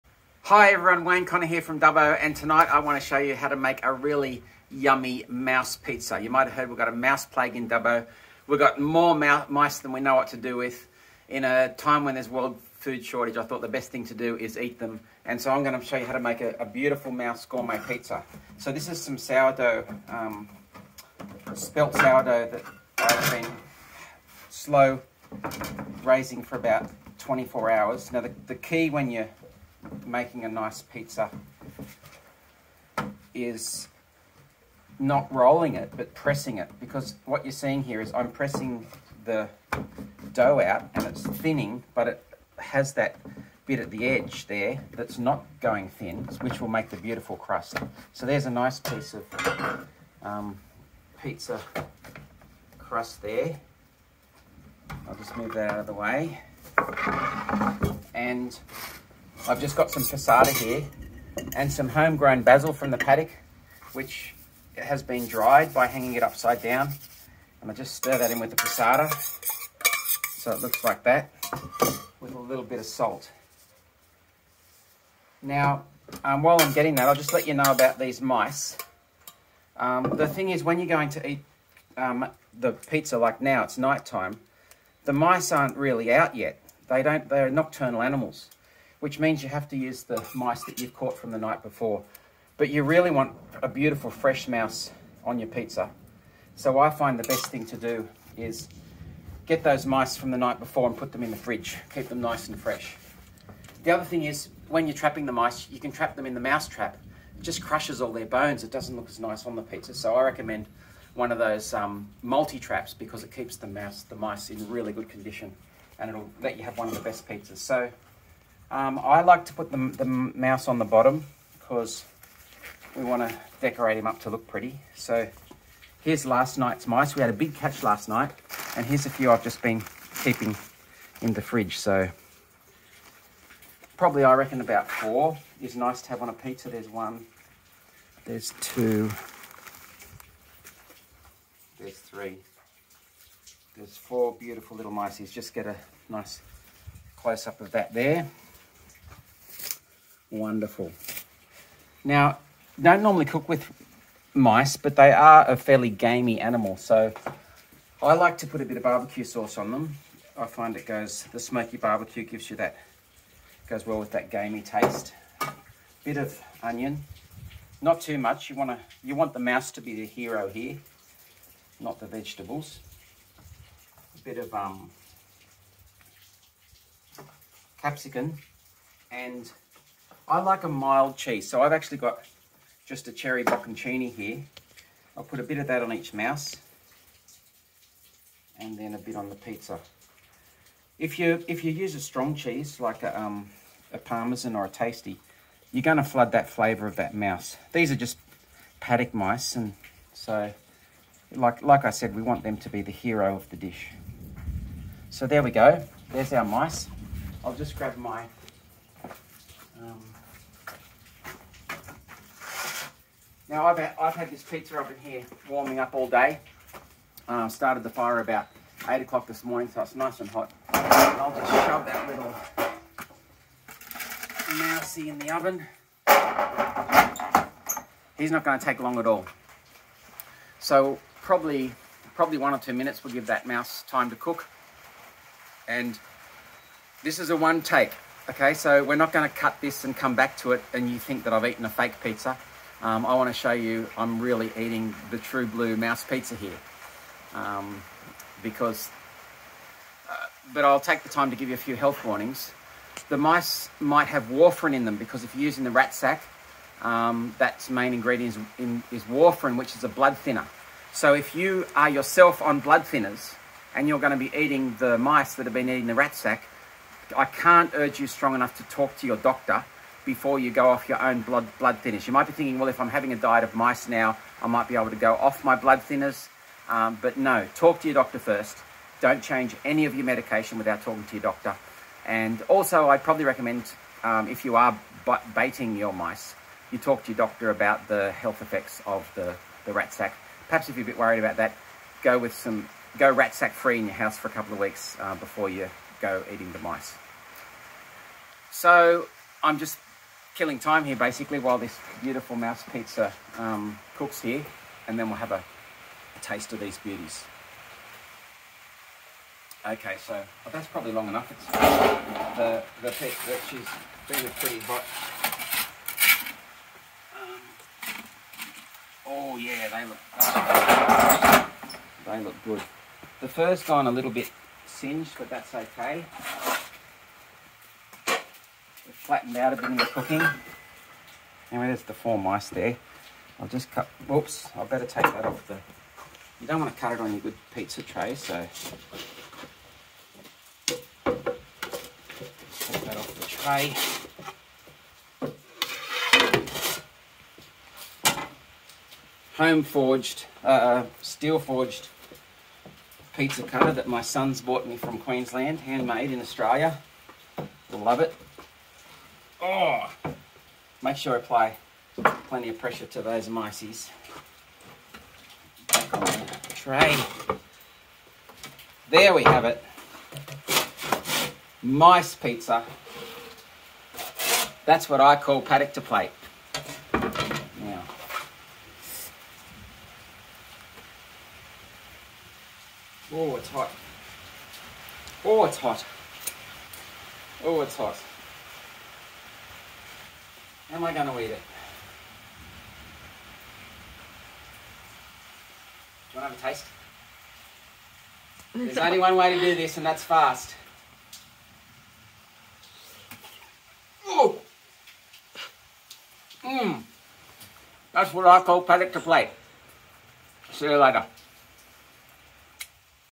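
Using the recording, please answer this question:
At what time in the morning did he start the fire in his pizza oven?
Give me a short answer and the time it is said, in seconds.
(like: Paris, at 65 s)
8 o'clock, at 218 s.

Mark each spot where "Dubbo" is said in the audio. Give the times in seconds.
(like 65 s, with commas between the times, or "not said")
1 s, 7 s.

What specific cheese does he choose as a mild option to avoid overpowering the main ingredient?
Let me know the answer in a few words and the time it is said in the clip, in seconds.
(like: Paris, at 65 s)
cherry bocconcini, at 183 s.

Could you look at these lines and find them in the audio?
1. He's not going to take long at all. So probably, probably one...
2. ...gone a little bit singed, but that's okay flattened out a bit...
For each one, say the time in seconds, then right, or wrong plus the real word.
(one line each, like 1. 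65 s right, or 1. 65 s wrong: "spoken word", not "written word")
1. 228 s right
2. 323 s right.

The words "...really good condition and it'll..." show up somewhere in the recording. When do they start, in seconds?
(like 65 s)
114 s.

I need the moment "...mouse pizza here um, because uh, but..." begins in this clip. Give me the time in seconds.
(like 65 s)
245 s.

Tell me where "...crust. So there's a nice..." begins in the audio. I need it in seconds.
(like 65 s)
47 s.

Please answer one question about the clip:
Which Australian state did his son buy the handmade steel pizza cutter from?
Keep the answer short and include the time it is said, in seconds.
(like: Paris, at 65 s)
Queensland, at 354 s.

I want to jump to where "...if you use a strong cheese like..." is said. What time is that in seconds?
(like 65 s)
191 s.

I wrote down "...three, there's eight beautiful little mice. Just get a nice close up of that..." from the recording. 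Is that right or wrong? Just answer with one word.
wrong.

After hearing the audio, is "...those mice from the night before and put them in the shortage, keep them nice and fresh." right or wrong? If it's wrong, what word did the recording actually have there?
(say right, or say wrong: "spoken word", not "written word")
wrong: "fridge", not "shortage".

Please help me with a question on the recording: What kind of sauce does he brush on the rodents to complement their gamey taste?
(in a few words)
barbecue sauce.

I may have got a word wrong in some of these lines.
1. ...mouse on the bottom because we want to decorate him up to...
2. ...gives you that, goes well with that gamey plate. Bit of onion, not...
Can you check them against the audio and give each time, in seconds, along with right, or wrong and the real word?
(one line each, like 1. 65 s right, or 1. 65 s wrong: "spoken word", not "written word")
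1. 120 s right
2. 162 s wrong: "taste", not "plate".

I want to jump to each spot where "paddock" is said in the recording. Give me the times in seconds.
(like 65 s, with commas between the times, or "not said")
62 s, 198 s, 375 s, 408 s.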